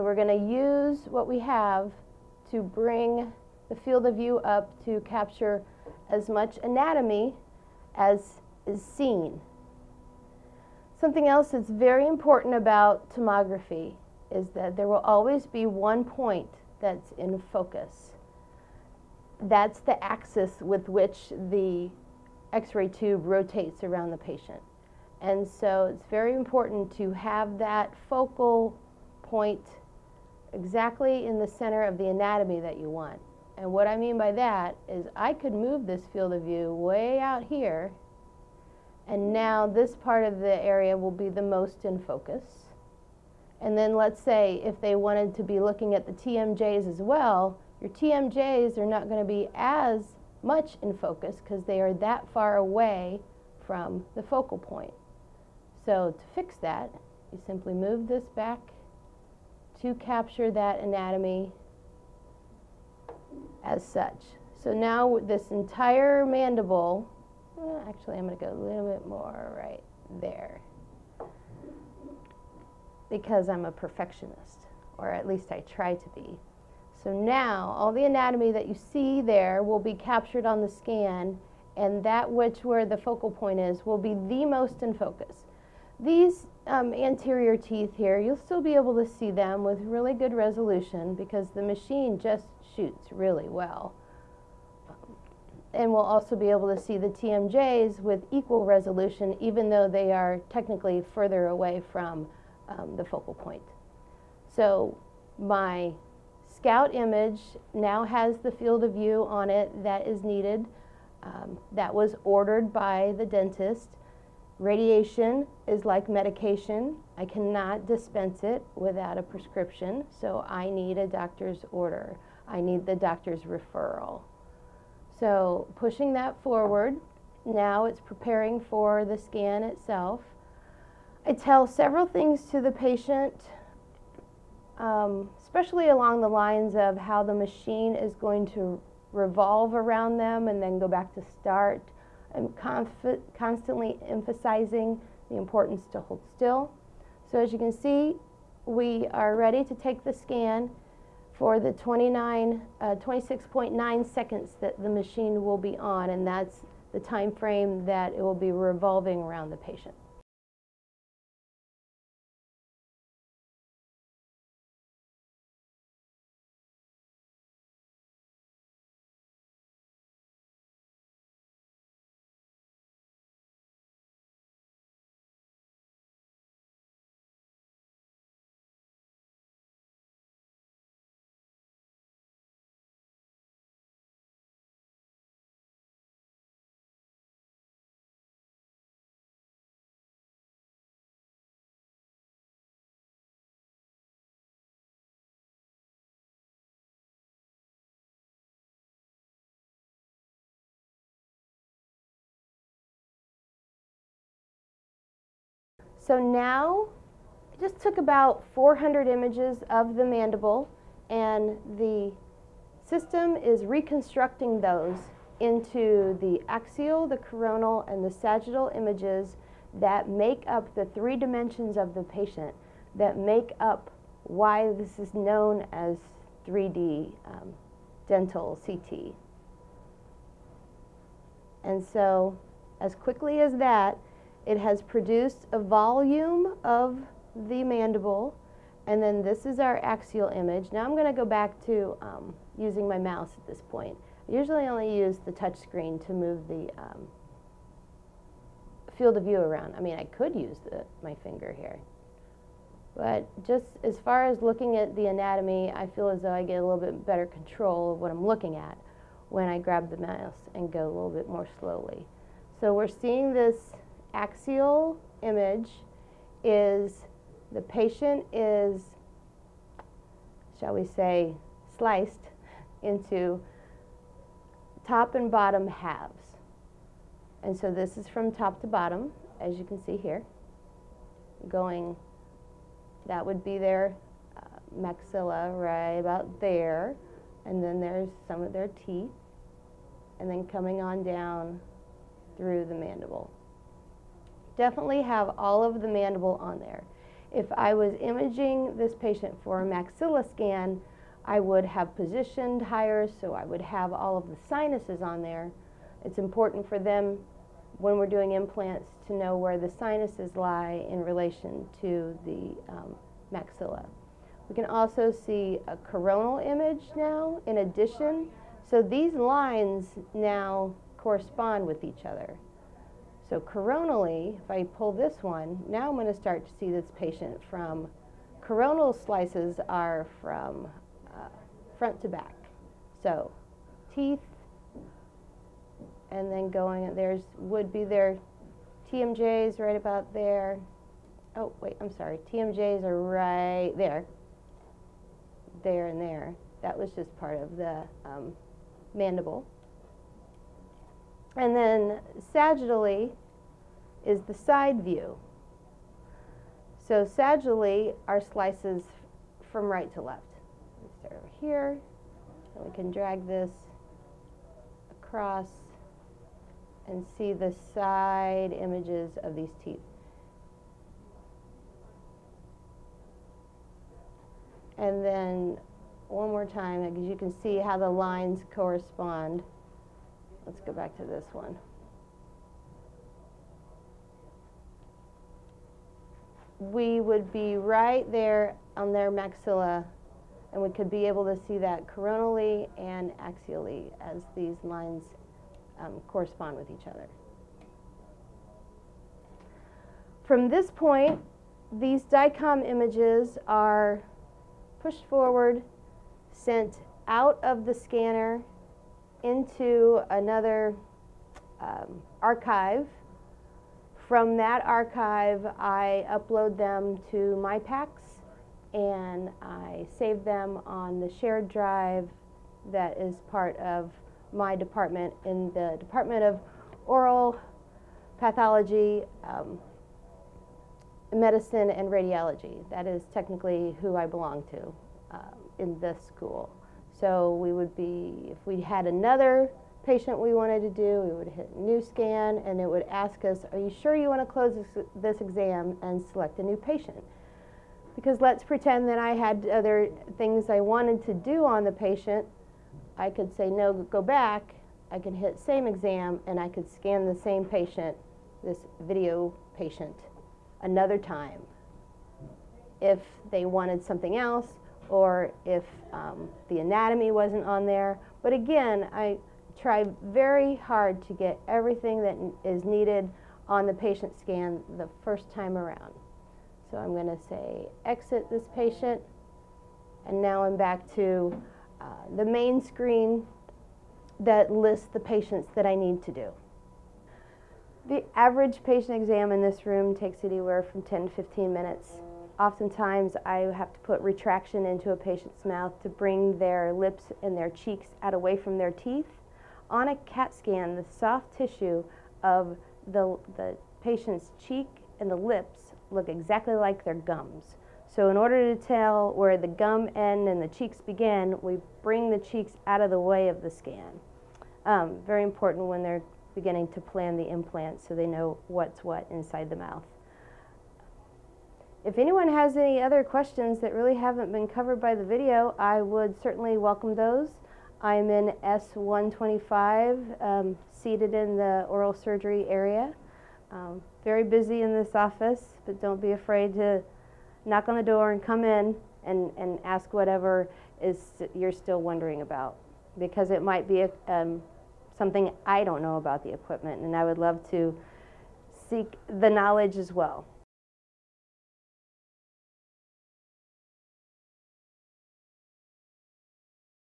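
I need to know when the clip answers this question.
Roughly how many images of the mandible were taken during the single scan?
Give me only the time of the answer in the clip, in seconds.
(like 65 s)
208 s.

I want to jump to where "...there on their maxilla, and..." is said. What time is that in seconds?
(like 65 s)
388 s.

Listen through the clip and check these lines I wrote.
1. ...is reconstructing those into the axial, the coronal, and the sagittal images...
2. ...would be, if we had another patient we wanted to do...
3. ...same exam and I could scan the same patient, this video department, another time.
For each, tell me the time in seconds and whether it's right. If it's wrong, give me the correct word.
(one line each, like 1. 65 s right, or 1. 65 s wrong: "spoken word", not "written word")
1. 213 s right
2. 437 s right
3. 455 s wrong: "patient", not "department".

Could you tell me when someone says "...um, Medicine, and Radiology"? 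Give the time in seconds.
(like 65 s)
429 s.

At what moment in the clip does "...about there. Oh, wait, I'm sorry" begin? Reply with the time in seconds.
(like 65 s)
339 s.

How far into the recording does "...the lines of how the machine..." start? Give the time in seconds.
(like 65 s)
136 s.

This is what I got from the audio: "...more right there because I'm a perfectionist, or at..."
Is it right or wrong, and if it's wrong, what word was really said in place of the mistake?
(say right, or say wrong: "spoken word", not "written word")
right.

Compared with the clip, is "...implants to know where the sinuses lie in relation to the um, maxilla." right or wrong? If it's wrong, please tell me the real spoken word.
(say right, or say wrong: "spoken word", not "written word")
right.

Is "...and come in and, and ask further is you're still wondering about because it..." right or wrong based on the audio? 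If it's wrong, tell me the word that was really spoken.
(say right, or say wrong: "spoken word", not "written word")
wrong: "whatever", not "further".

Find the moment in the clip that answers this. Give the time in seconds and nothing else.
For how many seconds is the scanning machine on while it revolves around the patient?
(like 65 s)
152 s.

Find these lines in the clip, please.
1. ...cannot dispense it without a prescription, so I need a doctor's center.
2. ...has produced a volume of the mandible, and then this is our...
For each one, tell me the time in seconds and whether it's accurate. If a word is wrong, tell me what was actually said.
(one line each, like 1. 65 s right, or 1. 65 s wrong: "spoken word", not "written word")
1. 117 s wrong: "order", not "center"
2. 234 s right.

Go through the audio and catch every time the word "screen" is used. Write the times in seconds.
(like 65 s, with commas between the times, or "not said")
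245 s, 482 s.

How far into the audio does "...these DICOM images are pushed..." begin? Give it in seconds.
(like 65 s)
401 s.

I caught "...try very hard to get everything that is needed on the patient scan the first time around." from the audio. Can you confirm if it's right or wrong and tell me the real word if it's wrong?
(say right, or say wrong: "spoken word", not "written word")
right.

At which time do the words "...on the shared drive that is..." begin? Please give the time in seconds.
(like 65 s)
420 s.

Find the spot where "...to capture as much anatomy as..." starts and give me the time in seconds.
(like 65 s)
4 s.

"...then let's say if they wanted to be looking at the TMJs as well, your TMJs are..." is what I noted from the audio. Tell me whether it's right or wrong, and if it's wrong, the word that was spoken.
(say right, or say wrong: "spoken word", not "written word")
right.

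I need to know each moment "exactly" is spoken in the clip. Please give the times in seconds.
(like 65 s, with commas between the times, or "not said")
30 s, 506 s.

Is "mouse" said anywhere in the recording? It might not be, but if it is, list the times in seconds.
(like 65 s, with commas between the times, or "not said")
242 s, 259 s.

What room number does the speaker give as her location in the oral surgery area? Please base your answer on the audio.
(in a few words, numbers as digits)
S125.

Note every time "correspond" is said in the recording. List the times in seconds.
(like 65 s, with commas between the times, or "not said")
320 s, 378 s, 396 s.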